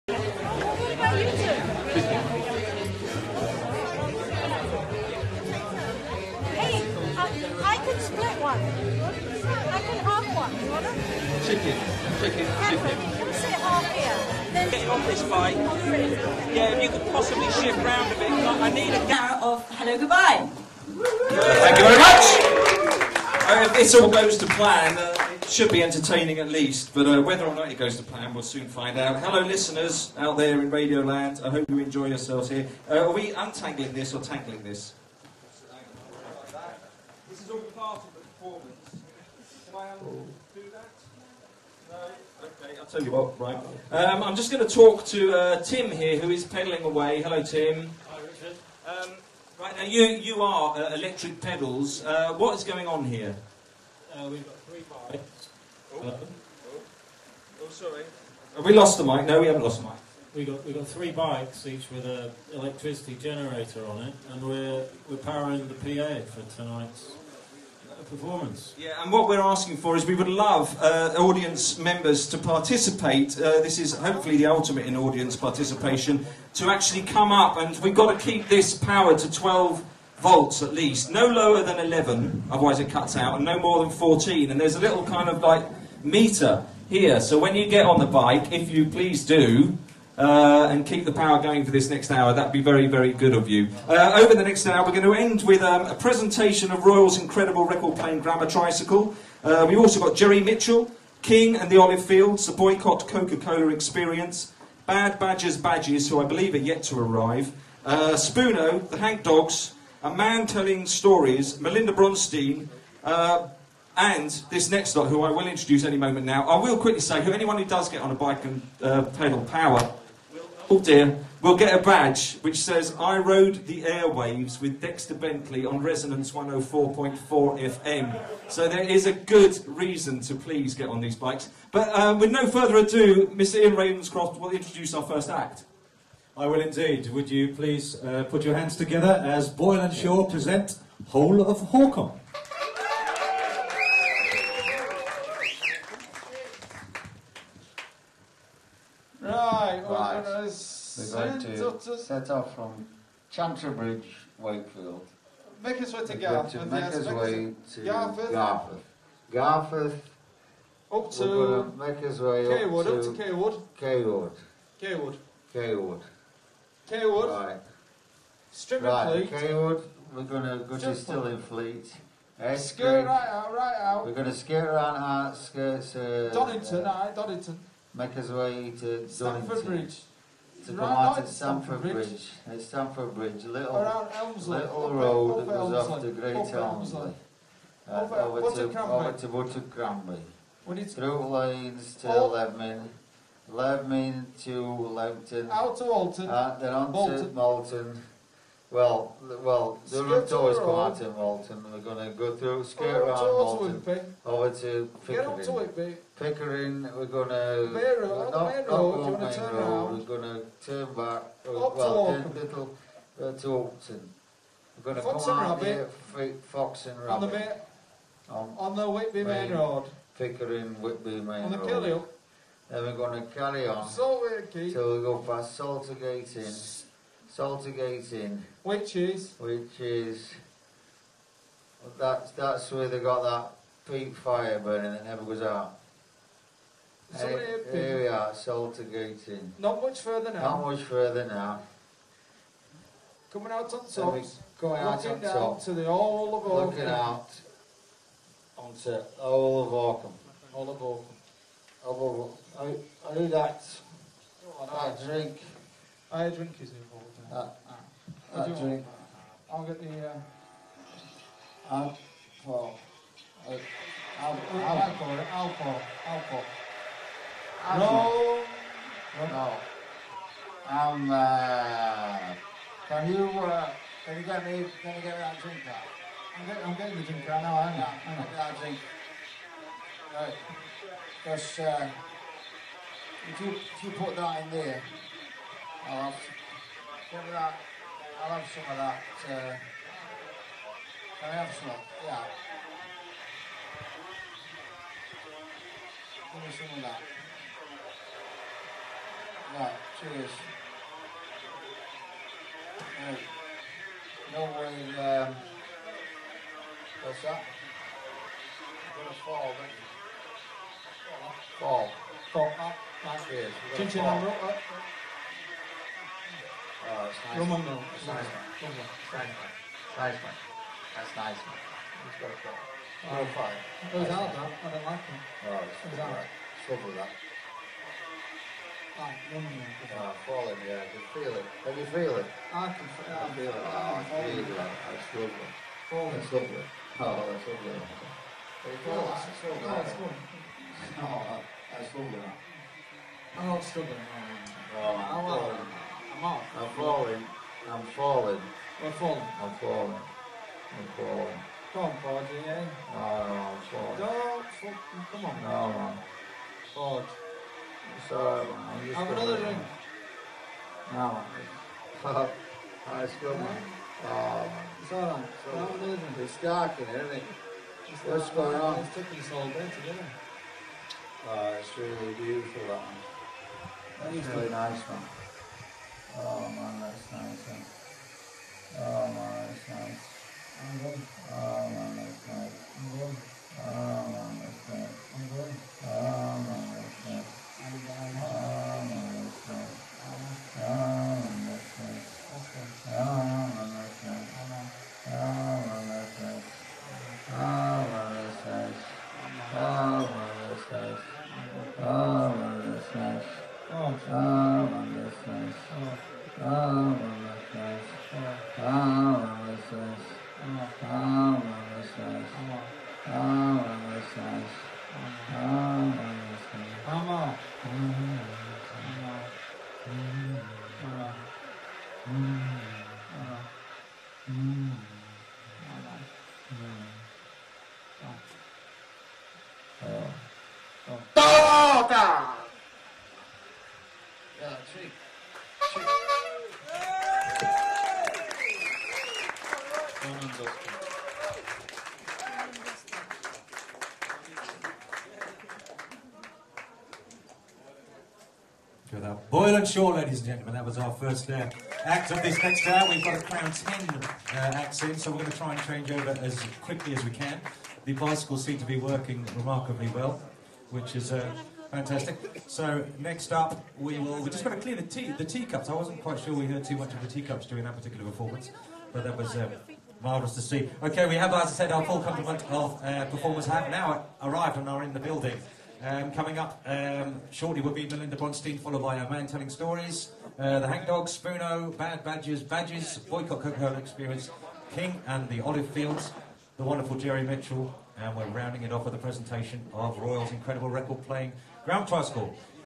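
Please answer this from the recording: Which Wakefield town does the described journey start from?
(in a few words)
Chantrybridge.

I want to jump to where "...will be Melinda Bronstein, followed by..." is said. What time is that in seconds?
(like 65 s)
477 s.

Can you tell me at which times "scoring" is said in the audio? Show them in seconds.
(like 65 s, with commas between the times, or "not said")
not said.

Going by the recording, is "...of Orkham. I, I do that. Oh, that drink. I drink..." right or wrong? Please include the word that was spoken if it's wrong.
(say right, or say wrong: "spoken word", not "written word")
right.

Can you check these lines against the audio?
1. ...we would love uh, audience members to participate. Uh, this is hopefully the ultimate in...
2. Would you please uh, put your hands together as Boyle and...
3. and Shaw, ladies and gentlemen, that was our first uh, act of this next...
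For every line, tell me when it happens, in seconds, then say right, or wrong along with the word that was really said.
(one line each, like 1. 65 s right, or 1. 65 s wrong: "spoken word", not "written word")
1. 70 s right
2. 137 s right
3. 449 s right.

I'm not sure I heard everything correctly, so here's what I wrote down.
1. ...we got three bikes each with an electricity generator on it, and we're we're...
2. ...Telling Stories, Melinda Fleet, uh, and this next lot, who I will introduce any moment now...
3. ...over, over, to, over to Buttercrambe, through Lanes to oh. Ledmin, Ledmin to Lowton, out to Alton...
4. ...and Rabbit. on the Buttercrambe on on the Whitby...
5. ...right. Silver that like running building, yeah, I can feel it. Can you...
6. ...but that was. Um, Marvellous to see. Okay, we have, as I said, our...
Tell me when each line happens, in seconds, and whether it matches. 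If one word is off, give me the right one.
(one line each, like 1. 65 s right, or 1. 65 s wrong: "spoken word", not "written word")
1. 60 s right
2. 110 s wrong: "Bronstein", not "Fleet"
3. 188 s right
4. 216 s wrong: "Rabbit", not "Buttercrambe"
5. 326 s wrong: "falling", not "building"
6. 468 s right.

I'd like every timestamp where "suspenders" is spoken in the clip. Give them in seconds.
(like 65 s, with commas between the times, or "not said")
not said.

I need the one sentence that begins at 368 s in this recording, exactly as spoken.
It's taking us all day together.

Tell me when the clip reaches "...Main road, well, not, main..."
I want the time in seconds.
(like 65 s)
207 s.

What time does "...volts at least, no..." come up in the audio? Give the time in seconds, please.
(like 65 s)
80 s.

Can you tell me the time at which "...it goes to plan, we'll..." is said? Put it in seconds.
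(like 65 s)
27 s.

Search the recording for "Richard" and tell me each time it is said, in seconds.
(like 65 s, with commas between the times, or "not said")
48 s.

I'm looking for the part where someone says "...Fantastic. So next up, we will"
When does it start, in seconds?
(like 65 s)
461 s.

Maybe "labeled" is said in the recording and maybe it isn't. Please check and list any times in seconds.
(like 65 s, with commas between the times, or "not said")
not said.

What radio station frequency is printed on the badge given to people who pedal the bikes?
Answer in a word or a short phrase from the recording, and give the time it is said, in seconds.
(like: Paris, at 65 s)
104.4 FM, at 125 s.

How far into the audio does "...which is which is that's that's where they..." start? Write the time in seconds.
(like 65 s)
228 s.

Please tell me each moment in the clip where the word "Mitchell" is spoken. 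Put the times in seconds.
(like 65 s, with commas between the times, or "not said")
100 s, 487 s.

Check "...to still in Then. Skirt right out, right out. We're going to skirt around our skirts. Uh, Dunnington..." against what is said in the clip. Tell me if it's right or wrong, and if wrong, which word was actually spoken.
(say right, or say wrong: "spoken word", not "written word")
wrong: "Fleet", not "Then".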